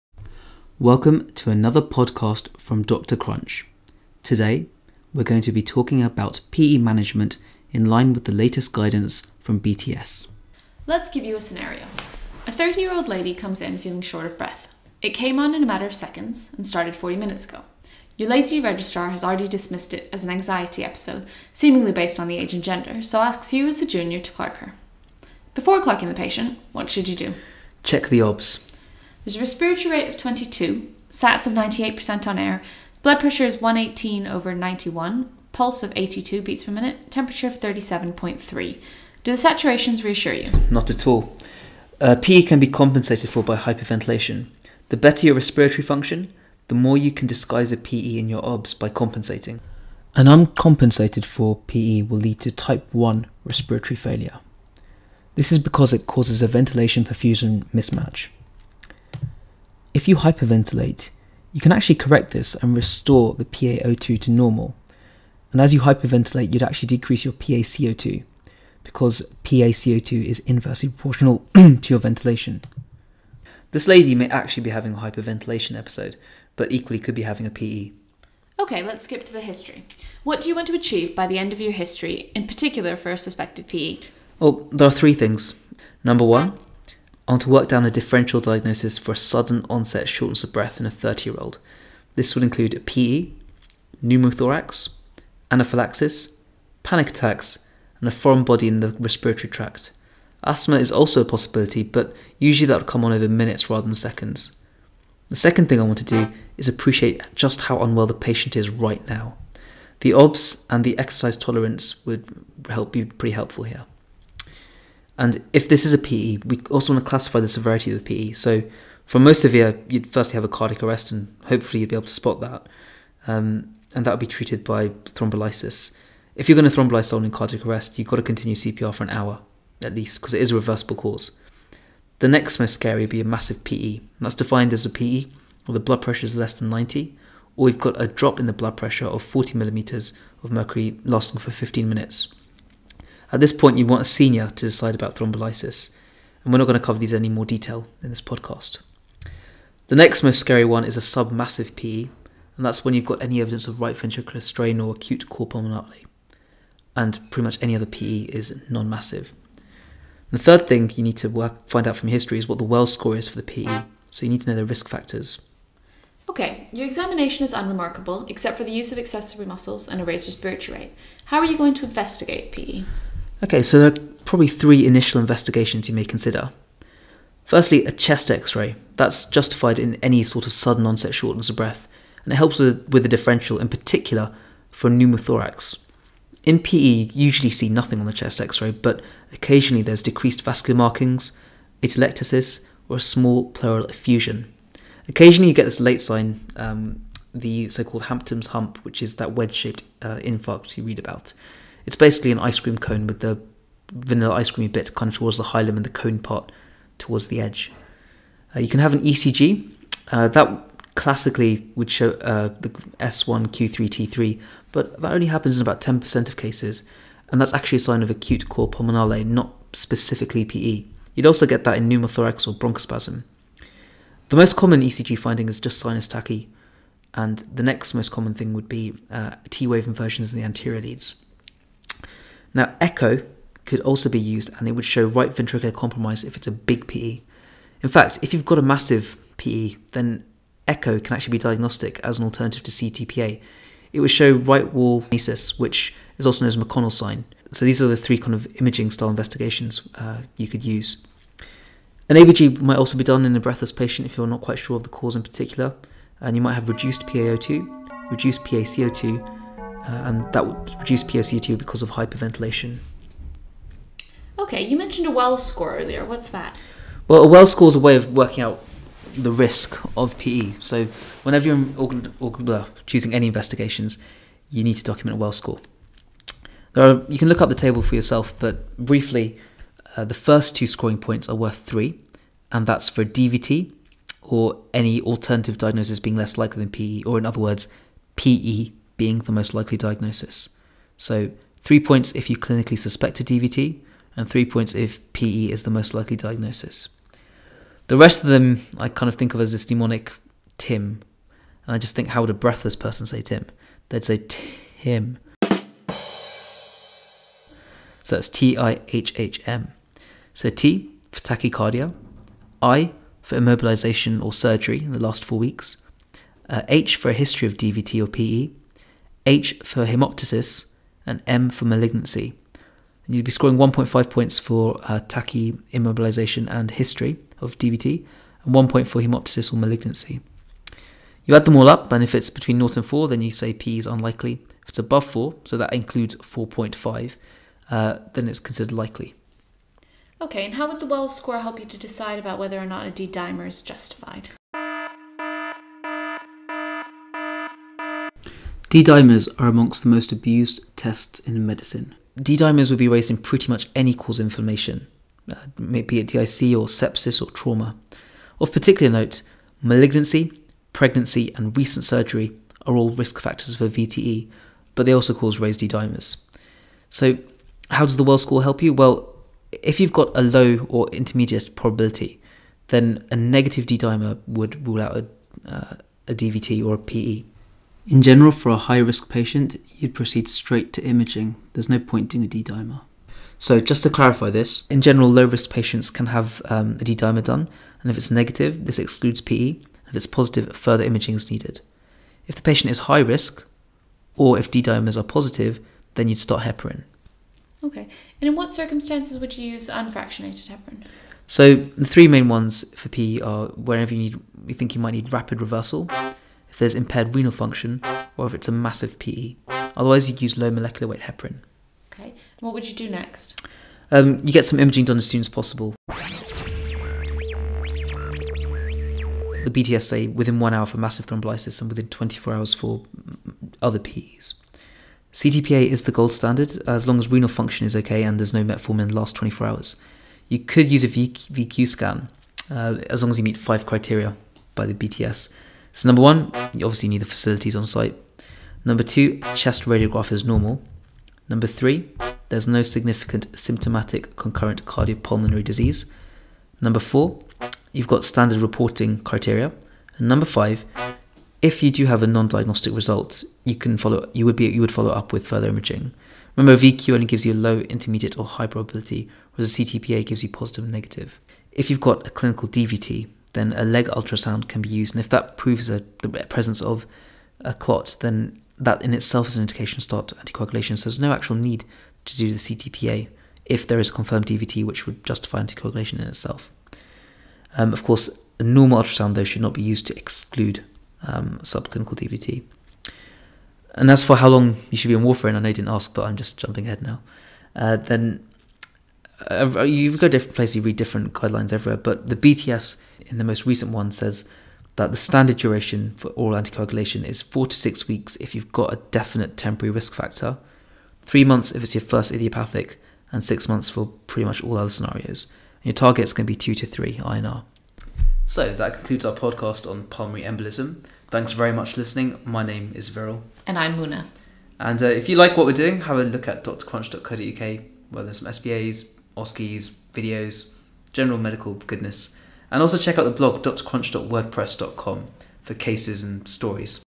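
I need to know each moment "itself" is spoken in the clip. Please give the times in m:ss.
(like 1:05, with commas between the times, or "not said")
7:48, 7:56.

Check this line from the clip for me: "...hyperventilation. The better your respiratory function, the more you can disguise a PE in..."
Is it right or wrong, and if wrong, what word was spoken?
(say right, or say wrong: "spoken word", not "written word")
right.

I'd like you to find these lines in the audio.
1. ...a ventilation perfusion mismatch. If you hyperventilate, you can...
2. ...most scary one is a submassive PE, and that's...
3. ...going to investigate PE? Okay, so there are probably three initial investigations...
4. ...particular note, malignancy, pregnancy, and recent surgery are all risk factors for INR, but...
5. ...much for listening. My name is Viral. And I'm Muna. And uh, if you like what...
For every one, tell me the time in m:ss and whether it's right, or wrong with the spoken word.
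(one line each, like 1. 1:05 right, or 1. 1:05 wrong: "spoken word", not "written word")
1. 0:56 right
2. 2:30 right
3. 2:51 right
4. 5:58 wrong: "VTE", not "INR"
5. 8:31 right.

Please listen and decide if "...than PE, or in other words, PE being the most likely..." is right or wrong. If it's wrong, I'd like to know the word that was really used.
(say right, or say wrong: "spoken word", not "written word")
right.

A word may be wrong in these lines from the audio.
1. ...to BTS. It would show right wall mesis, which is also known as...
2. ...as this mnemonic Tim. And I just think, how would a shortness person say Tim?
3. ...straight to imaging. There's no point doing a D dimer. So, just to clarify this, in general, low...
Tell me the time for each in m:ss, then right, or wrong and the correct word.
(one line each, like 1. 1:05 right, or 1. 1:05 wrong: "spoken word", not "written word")
1. 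4:02 wrong: "CTPA", not "BTS"
2. 4:59 wrong: "breathless", not "shortness"
3. 6:20 right.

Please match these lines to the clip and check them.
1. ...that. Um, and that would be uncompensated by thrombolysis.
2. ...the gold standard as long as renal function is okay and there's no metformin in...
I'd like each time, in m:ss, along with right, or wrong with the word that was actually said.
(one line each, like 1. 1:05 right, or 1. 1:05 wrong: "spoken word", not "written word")
1. 2:02 wrong: "treated", not "uncompensated"
2. 7:05 right.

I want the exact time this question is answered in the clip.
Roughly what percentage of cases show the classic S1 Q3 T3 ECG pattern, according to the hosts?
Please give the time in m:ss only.
3:35.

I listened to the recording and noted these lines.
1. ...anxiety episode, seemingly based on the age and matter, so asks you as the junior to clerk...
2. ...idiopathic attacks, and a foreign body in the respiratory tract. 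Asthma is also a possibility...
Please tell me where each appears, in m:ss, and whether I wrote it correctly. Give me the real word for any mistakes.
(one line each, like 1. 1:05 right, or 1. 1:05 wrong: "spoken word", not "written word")
1. 0:20 wrong: "gender", not "matter"
2. 1:36 wrong: "panic", not "idiopathic".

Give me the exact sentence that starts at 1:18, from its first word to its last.
Okay, let's skip to the history.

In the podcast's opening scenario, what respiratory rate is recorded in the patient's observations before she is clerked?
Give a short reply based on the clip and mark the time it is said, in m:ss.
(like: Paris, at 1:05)
22, at 0:30.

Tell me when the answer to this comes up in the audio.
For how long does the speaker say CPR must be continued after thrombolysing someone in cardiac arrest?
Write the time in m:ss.
2:09.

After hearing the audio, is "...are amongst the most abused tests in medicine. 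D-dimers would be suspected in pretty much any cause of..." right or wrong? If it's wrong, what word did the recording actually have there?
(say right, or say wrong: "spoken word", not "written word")
wrong: "raised", not "suspected".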